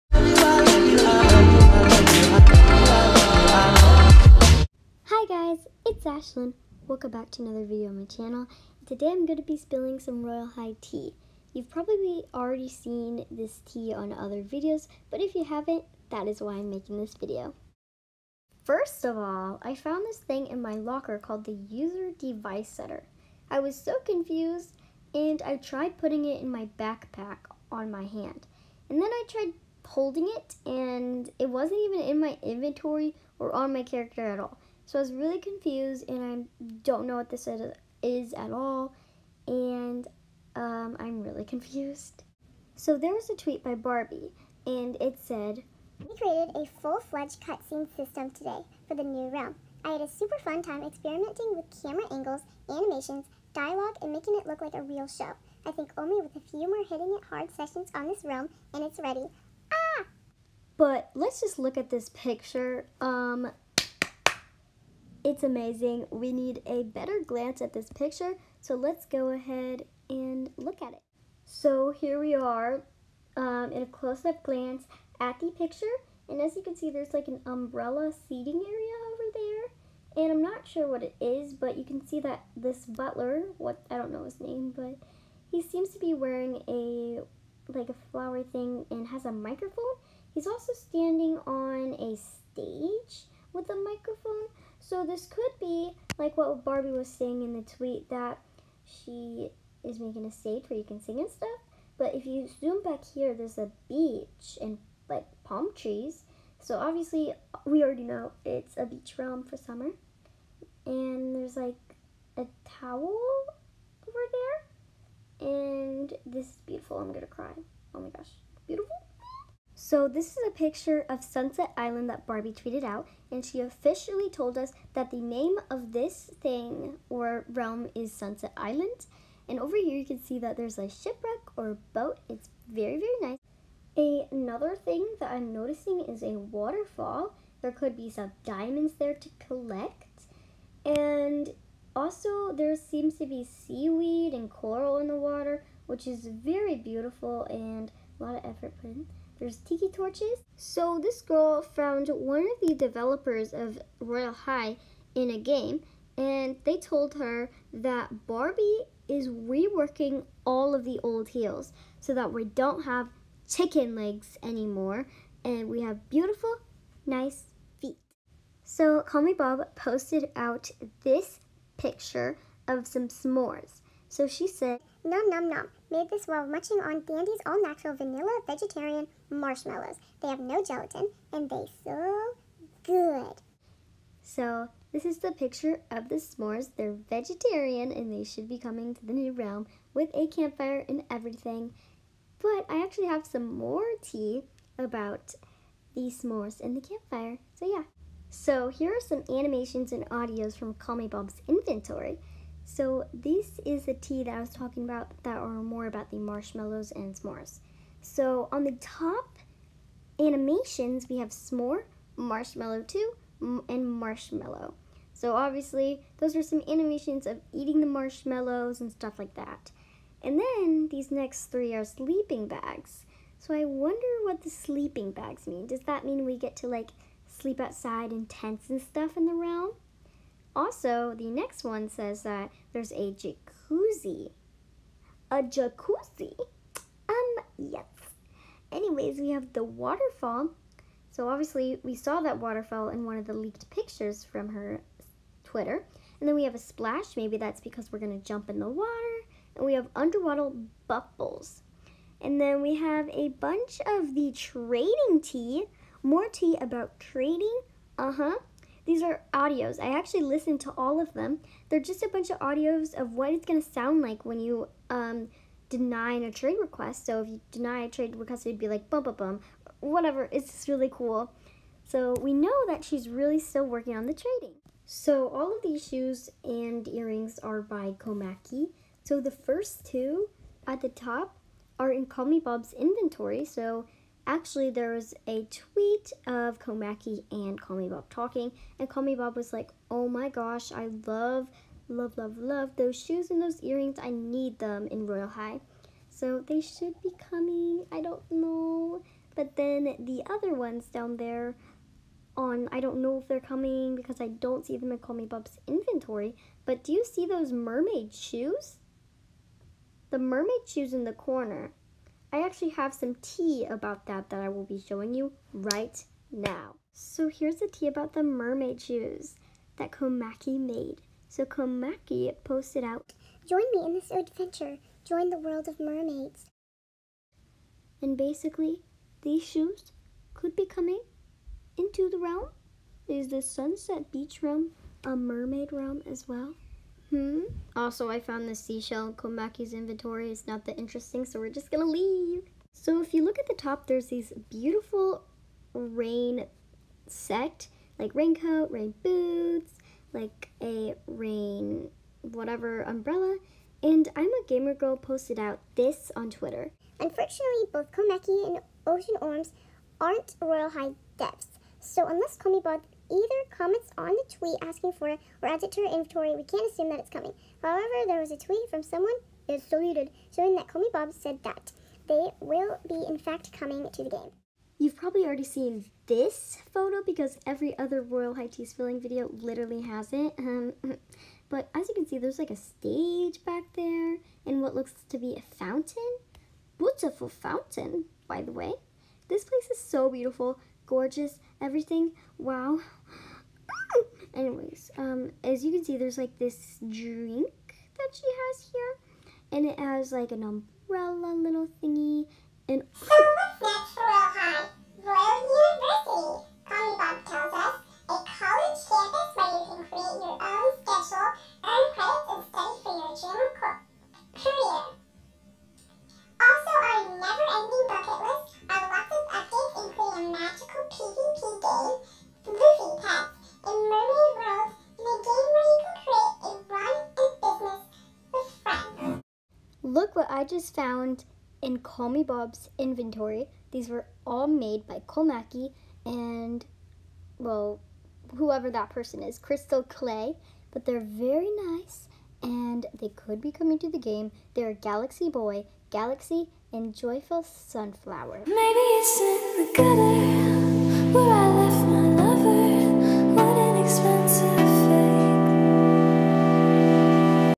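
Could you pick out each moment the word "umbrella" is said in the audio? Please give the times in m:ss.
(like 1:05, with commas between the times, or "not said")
1:17, 5:52, 6:40.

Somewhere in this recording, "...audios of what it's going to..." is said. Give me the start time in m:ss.
4:22.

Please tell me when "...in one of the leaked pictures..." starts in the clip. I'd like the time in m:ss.
4:02.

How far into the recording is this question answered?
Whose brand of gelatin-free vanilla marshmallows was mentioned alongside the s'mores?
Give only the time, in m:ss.
2:57.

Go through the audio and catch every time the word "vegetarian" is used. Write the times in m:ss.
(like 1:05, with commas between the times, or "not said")
2:58, 3:07.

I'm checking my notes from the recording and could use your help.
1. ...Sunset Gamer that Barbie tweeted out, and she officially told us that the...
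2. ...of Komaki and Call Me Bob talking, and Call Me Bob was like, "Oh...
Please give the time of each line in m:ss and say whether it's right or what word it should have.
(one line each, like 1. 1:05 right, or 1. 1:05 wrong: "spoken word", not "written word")
1. 2:01 wrong: "Island", not "Gamer"
2. 4:46 right.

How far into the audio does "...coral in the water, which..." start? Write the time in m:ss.
2:24.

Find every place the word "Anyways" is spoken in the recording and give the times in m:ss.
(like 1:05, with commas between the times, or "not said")
3:58, 6:34.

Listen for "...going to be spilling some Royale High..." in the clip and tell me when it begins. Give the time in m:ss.
0:09.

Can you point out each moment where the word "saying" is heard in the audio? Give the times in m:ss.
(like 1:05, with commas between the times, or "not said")
1:37.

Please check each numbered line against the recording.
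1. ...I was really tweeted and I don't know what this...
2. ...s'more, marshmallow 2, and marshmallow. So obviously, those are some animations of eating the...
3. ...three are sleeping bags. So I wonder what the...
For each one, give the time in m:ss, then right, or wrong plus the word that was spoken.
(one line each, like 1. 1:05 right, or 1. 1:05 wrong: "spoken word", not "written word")
1. 0:34 wrong: "confused", not "tweeted"
2. 3:31 right
3. 3:41 right.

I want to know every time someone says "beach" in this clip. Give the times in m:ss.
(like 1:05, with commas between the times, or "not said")
1:43, 1:48, 5:34.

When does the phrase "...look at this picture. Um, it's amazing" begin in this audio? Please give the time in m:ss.
1:01.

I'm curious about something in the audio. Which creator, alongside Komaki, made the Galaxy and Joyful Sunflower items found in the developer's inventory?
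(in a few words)
Crystal Clay.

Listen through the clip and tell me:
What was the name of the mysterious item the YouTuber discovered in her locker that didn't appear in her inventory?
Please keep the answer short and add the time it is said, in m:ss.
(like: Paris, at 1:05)
User Device Setter, at 0:21.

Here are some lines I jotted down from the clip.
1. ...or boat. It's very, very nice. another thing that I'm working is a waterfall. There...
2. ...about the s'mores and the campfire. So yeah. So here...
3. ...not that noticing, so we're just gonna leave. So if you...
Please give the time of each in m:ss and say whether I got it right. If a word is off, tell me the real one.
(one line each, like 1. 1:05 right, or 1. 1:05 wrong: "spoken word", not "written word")
1. 2:11 wrong: "noticing", not "working"
2. 3:14 right
3. 5:40 wrong: "interesting", not "noticing".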